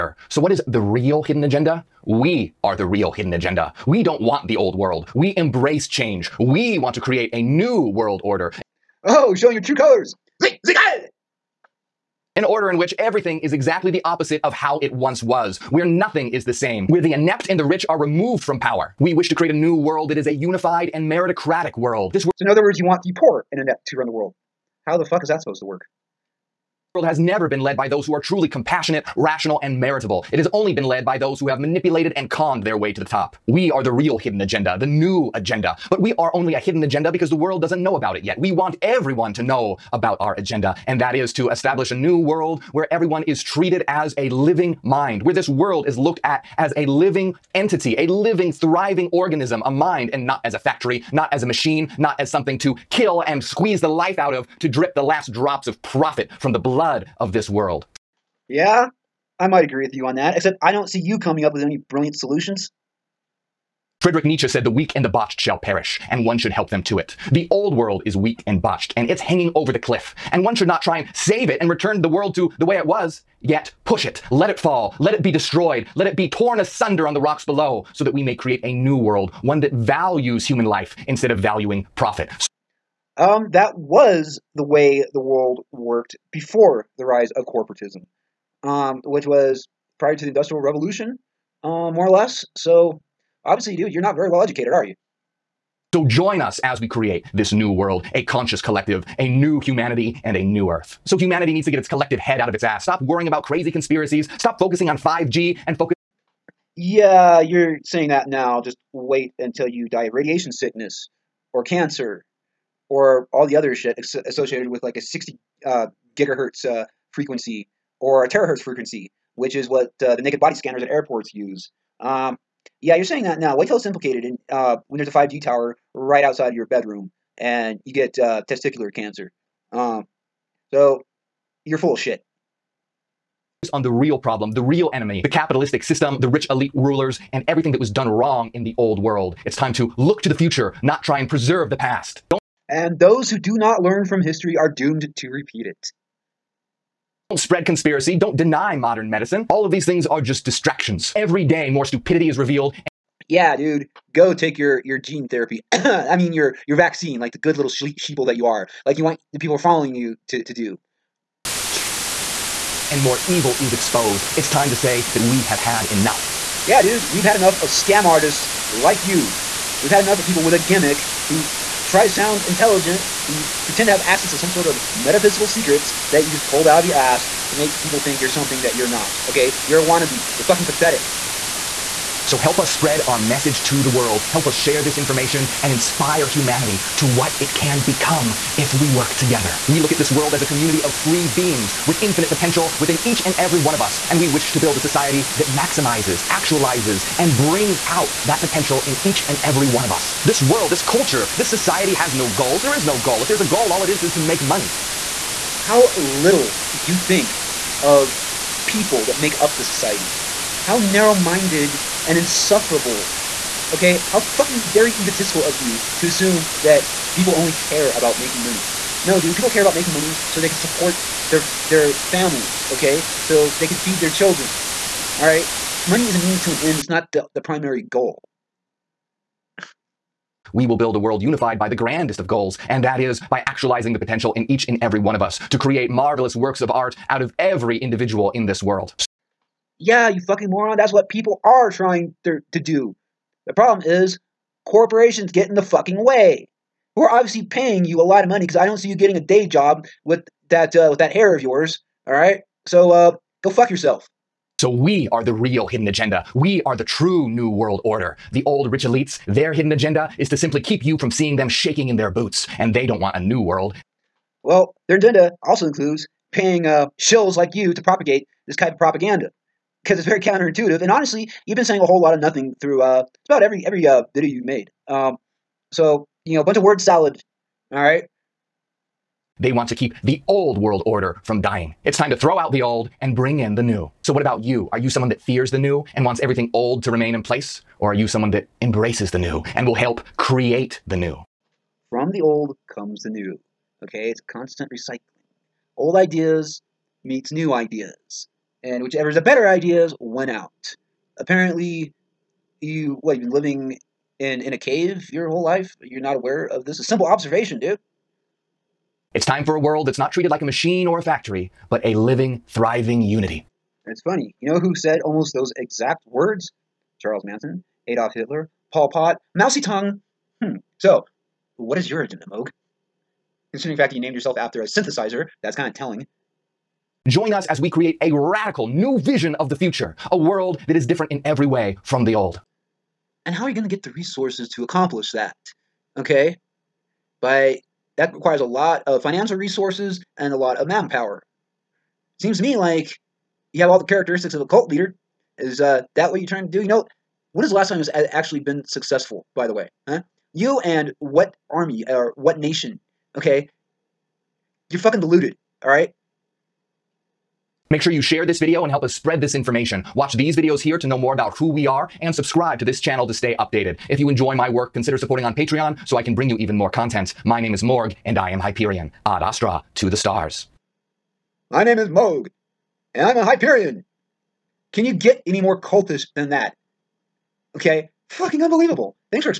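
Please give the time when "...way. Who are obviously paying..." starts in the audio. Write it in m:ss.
4:05.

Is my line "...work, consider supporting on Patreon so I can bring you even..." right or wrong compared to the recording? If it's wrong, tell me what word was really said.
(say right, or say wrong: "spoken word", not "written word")
right.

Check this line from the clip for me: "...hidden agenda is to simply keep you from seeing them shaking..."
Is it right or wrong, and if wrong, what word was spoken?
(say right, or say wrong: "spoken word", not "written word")
right.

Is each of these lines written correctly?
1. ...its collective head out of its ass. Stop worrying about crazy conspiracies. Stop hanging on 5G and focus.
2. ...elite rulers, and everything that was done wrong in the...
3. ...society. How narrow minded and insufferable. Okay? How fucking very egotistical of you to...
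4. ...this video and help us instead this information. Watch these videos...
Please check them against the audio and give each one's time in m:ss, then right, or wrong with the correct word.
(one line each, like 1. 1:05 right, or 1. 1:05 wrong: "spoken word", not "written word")
1. 1:41 wrong: "focusing", not "hanging"
2. 2:16 right
3. 3:29 right
4. 5:58 wrong: "spread", not "instead".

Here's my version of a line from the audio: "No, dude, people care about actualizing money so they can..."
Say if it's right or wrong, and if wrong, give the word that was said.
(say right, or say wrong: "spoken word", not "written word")
wrong: "making", not "actualizing".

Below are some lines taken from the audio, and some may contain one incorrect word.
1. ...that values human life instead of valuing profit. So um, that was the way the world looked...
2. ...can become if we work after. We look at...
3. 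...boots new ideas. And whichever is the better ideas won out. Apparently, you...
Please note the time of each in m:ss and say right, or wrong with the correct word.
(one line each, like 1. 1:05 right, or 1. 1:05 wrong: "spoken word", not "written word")
1. 1:19 wrong: "worked", not "looked"
2. 3:07 wrong: "together", not "after"
3. 4:57 wrong: "meets", not "boots".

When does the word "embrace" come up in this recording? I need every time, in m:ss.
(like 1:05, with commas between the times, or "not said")
0:05, 4:48.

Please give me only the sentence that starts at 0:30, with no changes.
It has only been led by those who have manipulated and conned their way to the top.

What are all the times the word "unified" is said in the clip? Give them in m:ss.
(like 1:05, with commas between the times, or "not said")
0:20, 3:51.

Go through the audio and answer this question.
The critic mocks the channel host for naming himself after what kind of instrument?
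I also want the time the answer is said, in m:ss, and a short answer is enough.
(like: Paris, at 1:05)
a synthesizer, at 5:24.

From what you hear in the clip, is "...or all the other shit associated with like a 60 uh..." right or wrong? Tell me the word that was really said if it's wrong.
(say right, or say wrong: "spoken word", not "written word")
right.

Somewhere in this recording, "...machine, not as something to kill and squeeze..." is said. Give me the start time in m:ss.
0:51.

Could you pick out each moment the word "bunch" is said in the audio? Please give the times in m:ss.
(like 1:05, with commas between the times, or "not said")
4:36.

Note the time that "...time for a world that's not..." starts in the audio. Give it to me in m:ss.
5:09.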